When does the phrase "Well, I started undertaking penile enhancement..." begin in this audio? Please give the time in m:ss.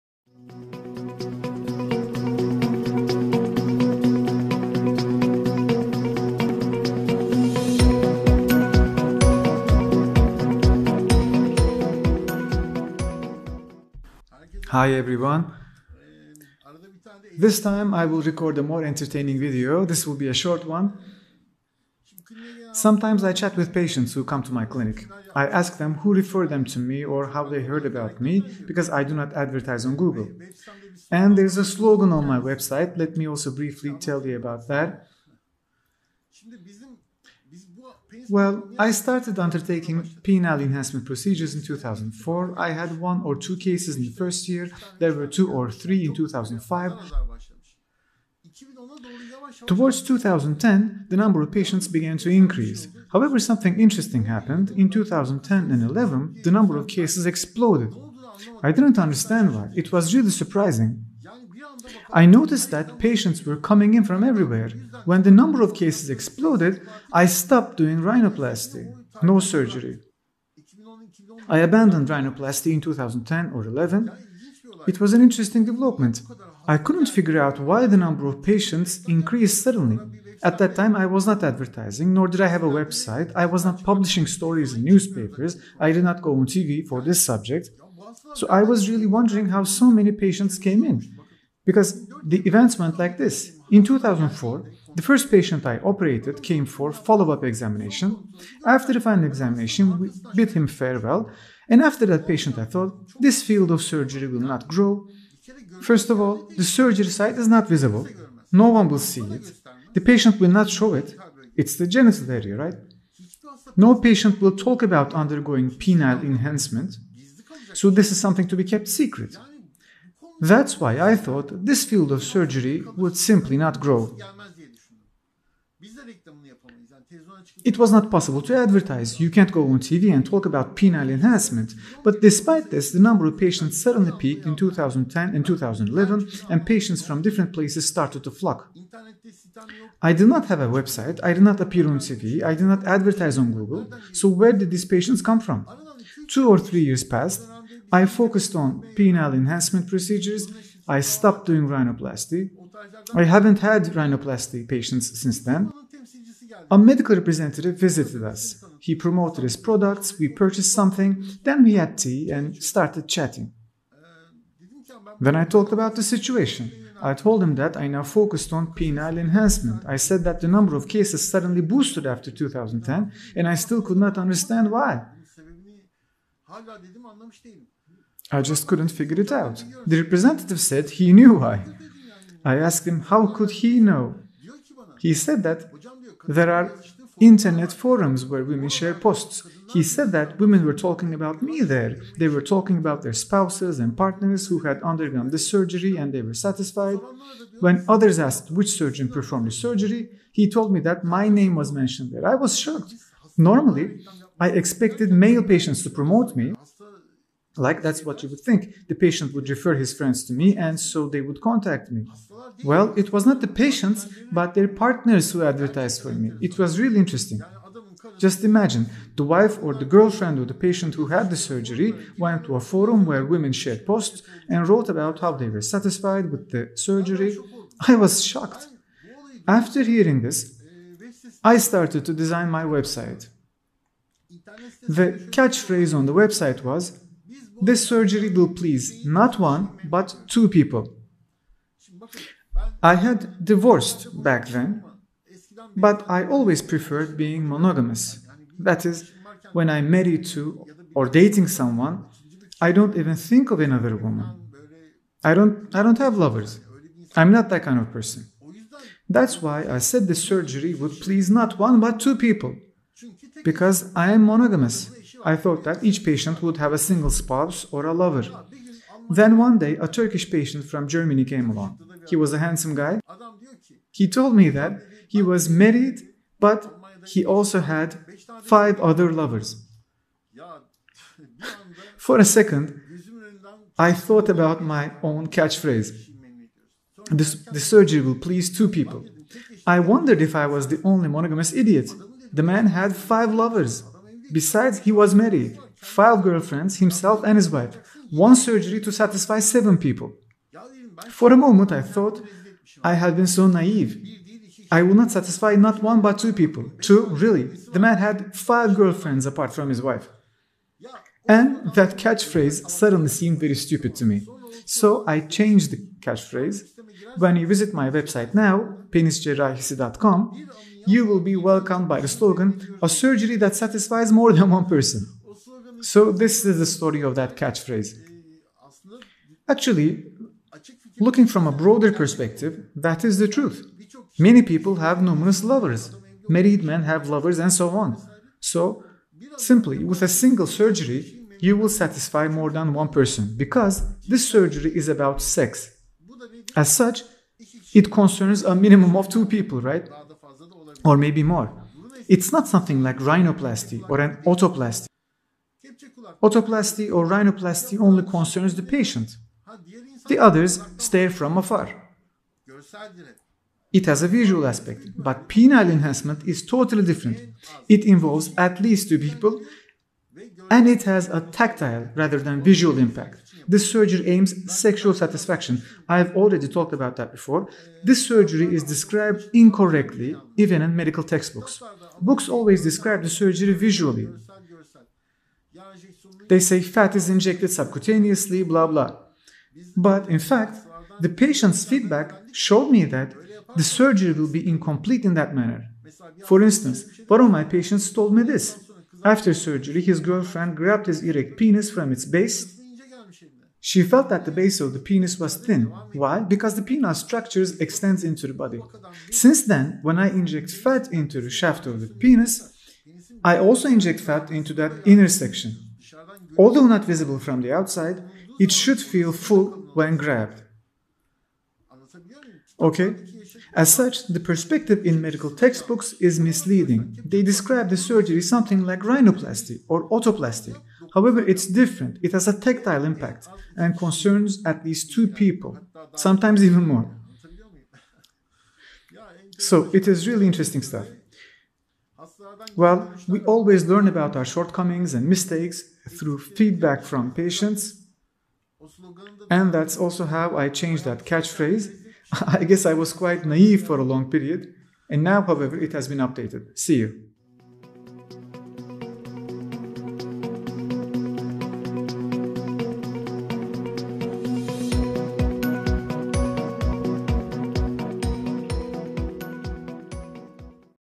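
0:38.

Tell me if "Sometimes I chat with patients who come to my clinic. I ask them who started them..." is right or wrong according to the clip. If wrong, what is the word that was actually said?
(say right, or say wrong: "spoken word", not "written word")
wrong: "referred", not "started".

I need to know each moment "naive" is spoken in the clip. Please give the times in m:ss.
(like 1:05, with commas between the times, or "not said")
5:03, 7:33.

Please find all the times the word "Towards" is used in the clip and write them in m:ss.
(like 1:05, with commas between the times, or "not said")
0:49.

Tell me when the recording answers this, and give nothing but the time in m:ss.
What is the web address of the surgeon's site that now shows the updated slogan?
5:18.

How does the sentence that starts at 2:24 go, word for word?
So, where did these patients come from?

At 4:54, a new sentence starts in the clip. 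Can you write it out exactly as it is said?
Besides, he was married, five girlfriends, himself and his wife, one surgery to satisfy seven people.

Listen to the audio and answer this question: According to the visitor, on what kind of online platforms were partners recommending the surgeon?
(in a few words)
internet forums.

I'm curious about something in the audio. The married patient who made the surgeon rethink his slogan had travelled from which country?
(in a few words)
Germany.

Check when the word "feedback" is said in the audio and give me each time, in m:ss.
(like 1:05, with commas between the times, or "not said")
6:31, 7:26.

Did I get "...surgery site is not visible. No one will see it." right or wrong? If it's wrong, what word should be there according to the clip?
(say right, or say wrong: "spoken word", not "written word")
right.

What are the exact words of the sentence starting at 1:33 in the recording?
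In 2004, the first patient I operated came for follow-up examination.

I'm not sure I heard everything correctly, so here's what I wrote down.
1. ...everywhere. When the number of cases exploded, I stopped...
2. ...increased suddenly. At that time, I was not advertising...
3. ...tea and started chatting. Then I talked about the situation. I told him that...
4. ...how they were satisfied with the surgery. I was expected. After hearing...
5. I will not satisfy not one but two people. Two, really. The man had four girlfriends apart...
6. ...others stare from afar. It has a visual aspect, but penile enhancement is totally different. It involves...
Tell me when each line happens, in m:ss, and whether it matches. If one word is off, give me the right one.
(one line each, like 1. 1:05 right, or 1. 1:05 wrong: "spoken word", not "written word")
1. 1:04 right
2. 1:19 right
3. 2:41 right
4. 3:45 wrong: "shocked", not "expected"
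5. 5:04 wrong: "five", not "four"
6. 6:00 right.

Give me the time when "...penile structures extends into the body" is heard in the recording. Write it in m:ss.
6:46.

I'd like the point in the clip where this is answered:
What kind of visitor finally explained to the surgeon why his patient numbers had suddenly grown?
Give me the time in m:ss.
2:36.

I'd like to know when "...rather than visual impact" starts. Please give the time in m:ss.
6:11.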